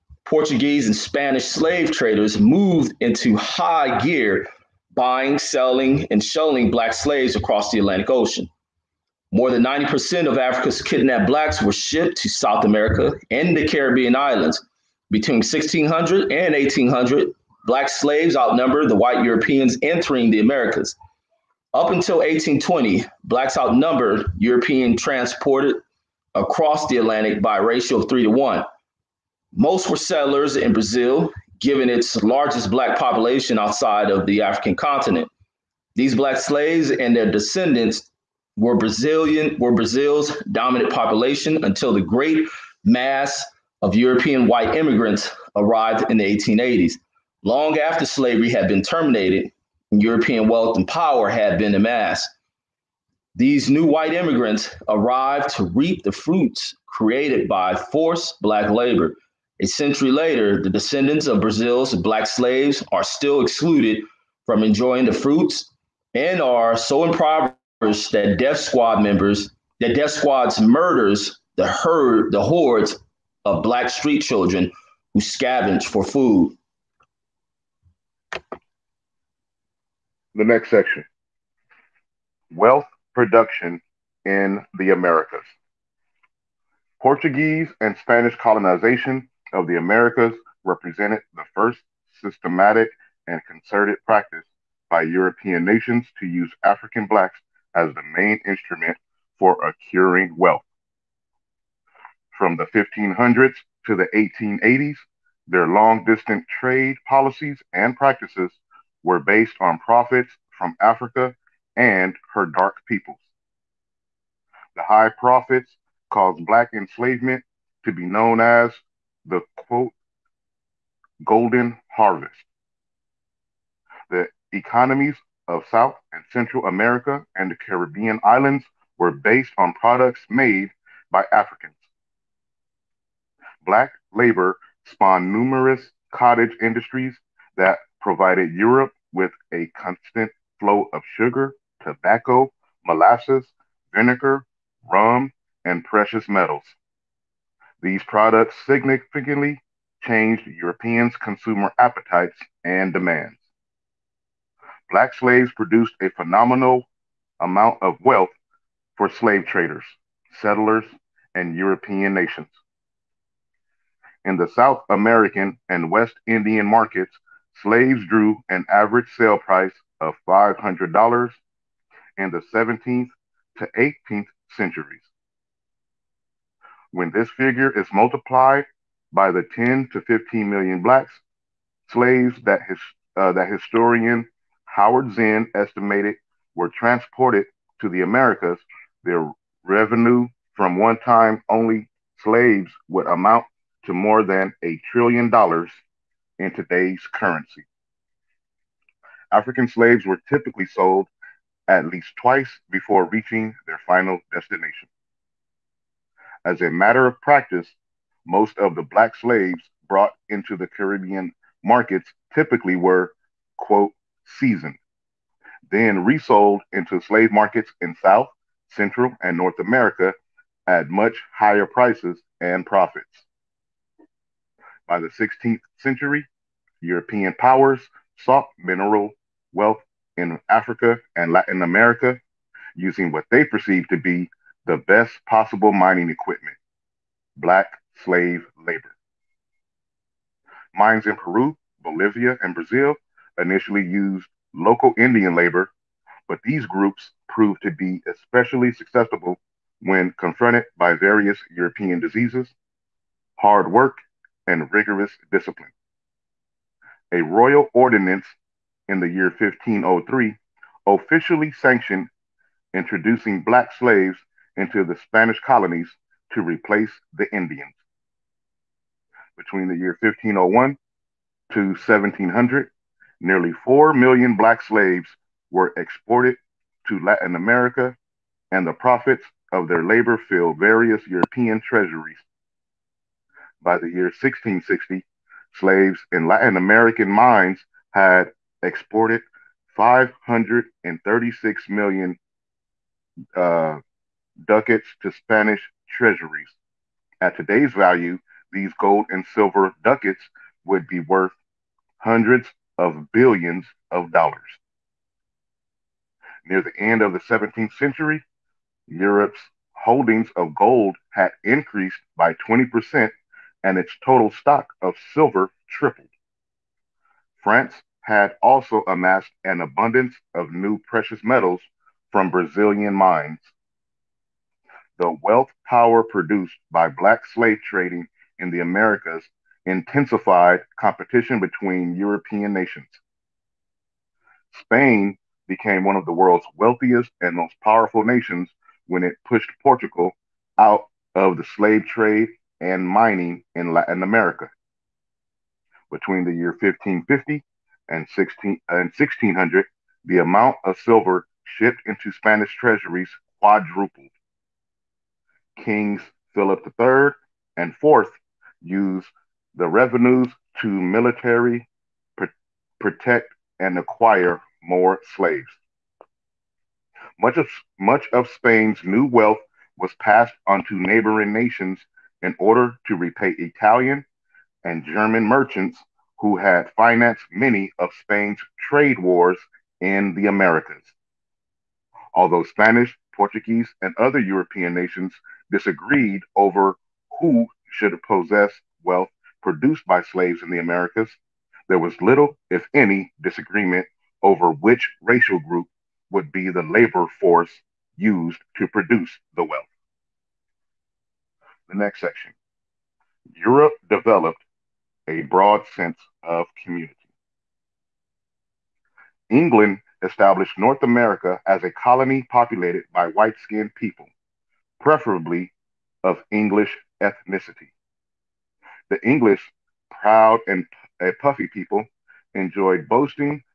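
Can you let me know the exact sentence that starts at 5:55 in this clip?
Kings Philip III and IV used the revenues to military pr- protect and acquire more slaves.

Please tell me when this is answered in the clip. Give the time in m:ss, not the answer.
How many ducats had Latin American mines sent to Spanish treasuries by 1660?
4:49.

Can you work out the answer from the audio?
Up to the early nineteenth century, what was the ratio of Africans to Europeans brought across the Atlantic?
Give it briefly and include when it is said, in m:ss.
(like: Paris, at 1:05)
3 to 1, at 0:28.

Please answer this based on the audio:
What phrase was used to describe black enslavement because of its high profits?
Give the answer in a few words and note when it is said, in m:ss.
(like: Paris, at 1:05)
golden harvest, at 2:01.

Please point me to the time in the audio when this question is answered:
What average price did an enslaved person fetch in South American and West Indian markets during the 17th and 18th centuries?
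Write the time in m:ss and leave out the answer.
2:50.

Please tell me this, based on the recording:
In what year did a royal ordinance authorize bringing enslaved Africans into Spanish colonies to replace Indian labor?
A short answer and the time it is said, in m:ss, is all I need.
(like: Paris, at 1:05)
1503, at 4:19.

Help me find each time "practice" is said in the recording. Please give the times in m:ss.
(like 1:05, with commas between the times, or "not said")
1:34, 1:47, 3:27.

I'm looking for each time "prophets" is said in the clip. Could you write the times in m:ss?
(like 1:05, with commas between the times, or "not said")
1:49, 1:55.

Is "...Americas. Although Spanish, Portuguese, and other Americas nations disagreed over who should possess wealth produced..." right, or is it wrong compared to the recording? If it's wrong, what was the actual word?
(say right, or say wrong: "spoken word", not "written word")
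wrong: "European", not "Americas".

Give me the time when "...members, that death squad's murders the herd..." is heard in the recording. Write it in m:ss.
1:09.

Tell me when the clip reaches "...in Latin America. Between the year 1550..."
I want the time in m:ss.
5:43.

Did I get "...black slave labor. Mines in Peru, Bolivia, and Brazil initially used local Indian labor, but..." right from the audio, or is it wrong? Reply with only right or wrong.
right.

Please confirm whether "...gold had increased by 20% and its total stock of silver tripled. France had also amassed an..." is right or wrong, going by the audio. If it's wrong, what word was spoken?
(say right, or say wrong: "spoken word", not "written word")
right.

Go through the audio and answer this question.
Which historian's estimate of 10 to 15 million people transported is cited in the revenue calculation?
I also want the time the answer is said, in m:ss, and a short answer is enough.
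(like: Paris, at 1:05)
Howard Zinn, at 3:04.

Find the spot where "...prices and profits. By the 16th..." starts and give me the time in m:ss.
3:41.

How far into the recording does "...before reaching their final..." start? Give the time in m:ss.
3:22.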